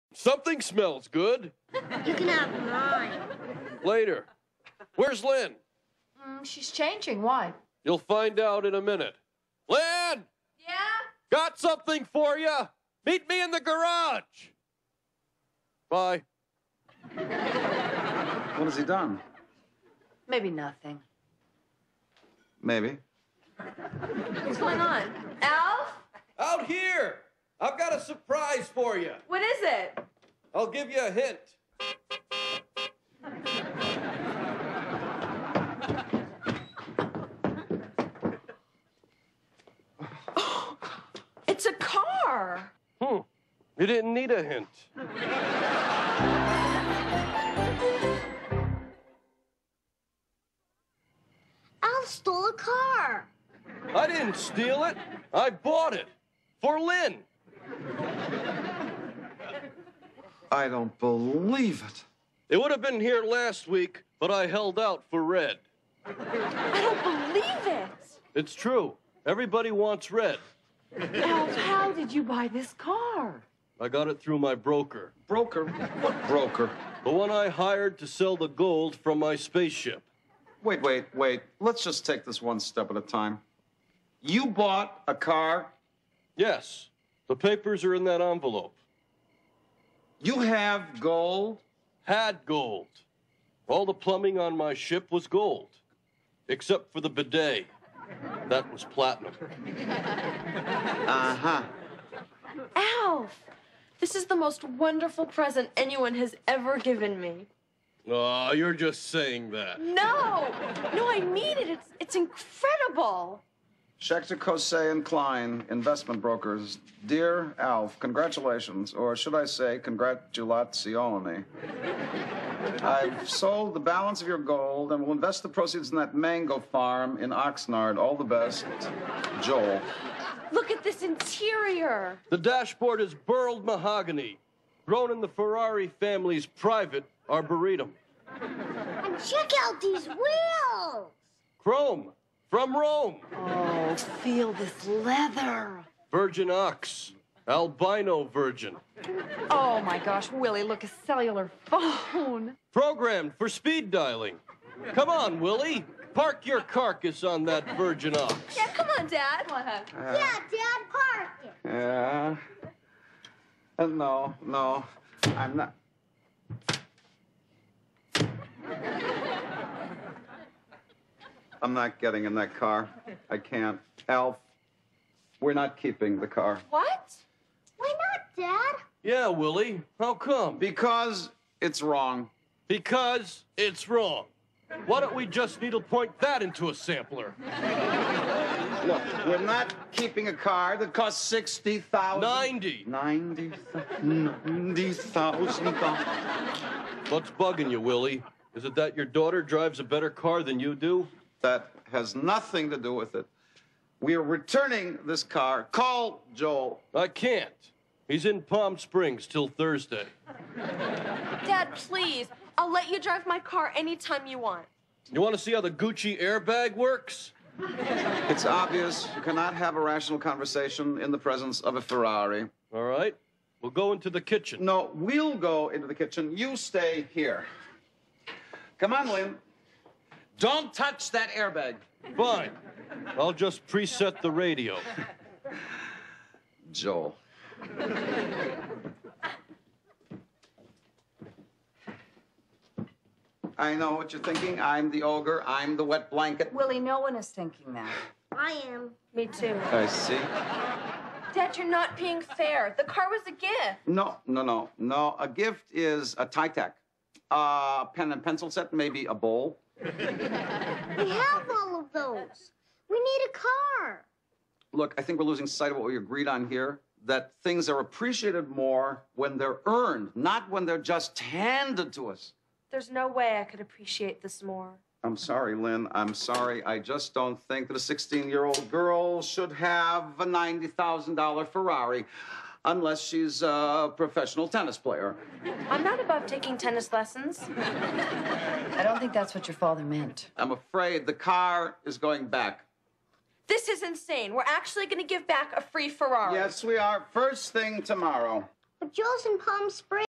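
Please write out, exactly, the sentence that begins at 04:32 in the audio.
There's no way I could appreciate this more.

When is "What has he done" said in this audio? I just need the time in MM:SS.
00:17.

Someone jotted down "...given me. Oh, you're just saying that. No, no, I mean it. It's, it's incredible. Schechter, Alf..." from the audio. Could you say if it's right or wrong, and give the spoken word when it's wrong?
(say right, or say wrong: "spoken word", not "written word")
wrong: "Cosay", not "Alf".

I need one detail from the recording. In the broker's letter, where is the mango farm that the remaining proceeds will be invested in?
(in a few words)
Oxnard.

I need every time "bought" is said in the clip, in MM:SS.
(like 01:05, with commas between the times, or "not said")
00:55, 01:24.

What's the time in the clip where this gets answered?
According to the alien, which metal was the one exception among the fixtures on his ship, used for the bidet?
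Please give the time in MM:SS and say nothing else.
01:38.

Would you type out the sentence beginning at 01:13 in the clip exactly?
I got it through my broker.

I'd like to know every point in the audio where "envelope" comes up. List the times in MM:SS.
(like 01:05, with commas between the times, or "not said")
01:28.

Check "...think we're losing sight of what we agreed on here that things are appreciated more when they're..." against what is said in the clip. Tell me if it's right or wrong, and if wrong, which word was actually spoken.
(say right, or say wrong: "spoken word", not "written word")
right.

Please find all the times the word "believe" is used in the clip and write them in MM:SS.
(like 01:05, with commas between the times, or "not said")
01:00, 01:07.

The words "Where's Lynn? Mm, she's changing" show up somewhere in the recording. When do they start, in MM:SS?
00:04.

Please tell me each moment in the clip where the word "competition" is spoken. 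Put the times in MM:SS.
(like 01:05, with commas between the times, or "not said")
not said.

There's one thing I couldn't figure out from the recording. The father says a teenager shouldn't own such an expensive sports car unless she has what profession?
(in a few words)
Professional tennis player.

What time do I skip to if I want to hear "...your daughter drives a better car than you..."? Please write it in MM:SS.
03:18.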